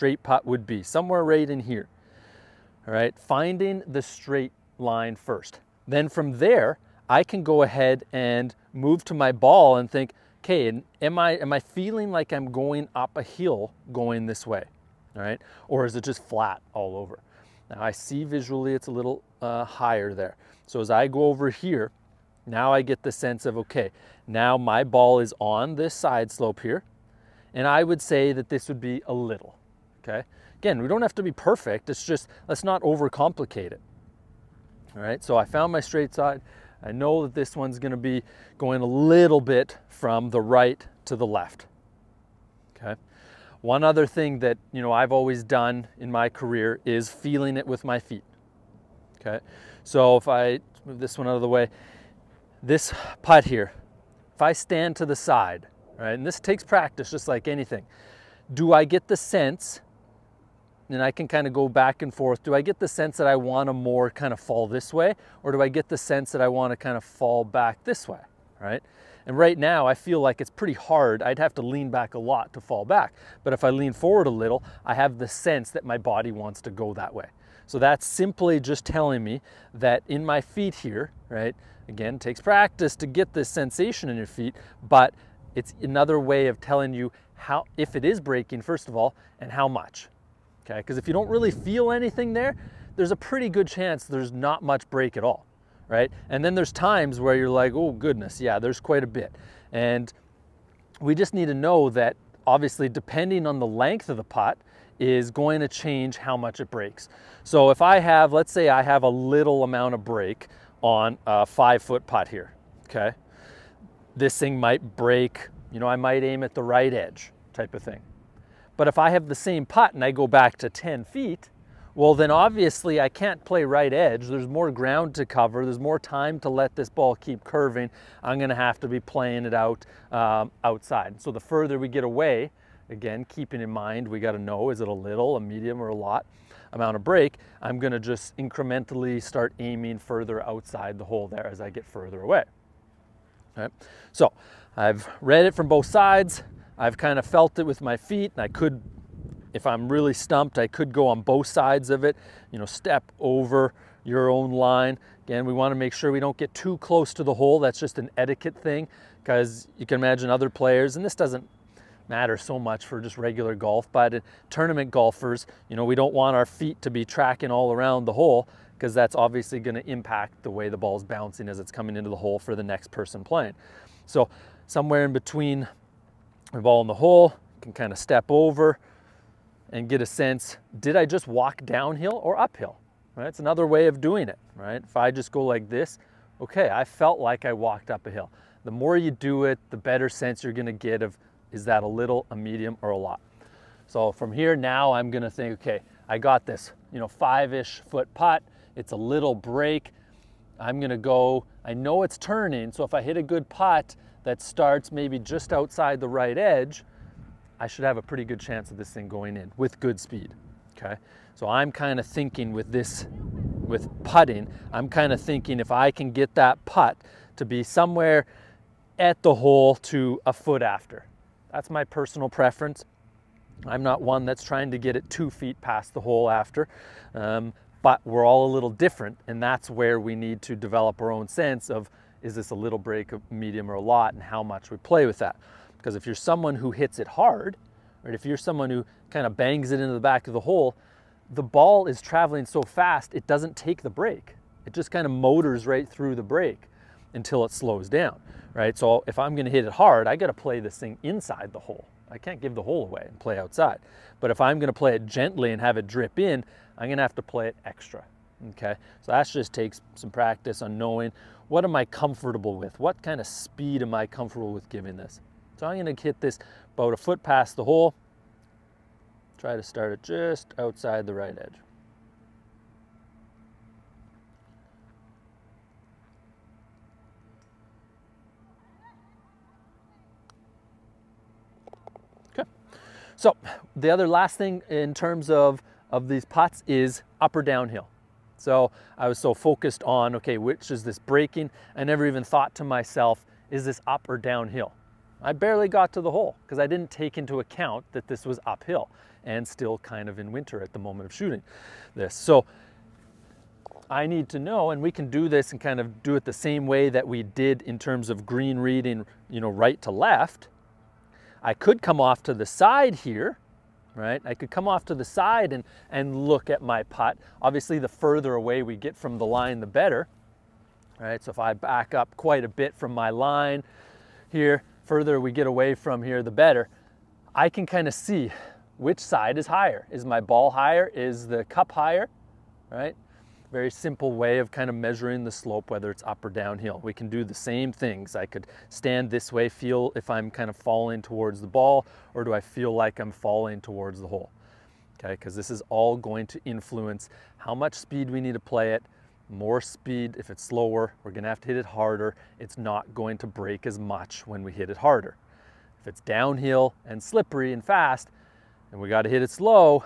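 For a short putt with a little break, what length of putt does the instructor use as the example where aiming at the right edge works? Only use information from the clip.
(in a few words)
5 feet.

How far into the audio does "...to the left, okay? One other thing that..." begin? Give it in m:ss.
0:41.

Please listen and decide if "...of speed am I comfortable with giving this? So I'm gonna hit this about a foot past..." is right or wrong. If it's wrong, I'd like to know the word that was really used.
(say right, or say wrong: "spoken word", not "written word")
right.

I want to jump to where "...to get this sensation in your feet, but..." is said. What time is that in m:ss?
1:22.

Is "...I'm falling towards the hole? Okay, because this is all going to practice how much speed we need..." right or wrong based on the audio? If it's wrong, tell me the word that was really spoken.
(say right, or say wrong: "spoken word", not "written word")
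wrong: "influence", not "practice".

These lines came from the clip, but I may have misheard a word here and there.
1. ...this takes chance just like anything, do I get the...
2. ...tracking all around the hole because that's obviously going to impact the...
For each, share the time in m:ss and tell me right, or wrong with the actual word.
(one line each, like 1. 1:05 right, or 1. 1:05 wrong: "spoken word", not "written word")
1. 0:56 wrong: "practice", not "chance"
2. 2:47 right.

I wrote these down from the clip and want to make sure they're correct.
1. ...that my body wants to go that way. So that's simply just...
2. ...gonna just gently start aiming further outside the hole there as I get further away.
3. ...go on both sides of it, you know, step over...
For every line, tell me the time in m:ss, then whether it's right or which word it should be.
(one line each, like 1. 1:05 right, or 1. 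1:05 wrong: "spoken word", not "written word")
1. 1:15 right
2. 2:17 wrong: "incrementally", not "gently"
3. 2:30 right.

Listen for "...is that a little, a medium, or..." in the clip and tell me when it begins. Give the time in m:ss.
3:11.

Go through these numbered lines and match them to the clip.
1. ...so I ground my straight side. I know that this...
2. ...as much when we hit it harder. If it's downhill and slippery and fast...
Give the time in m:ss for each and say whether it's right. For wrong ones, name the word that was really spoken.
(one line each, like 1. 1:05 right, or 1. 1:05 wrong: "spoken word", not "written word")
1. 0:35 wrong: "found", not "ground"
2. 5:53 right.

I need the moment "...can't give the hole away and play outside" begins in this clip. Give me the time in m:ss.
4:12.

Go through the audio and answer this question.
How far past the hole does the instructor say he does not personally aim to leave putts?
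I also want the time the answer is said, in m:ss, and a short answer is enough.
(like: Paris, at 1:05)
2 feet, at 3:45.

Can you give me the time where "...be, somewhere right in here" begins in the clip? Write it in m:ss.
0:00.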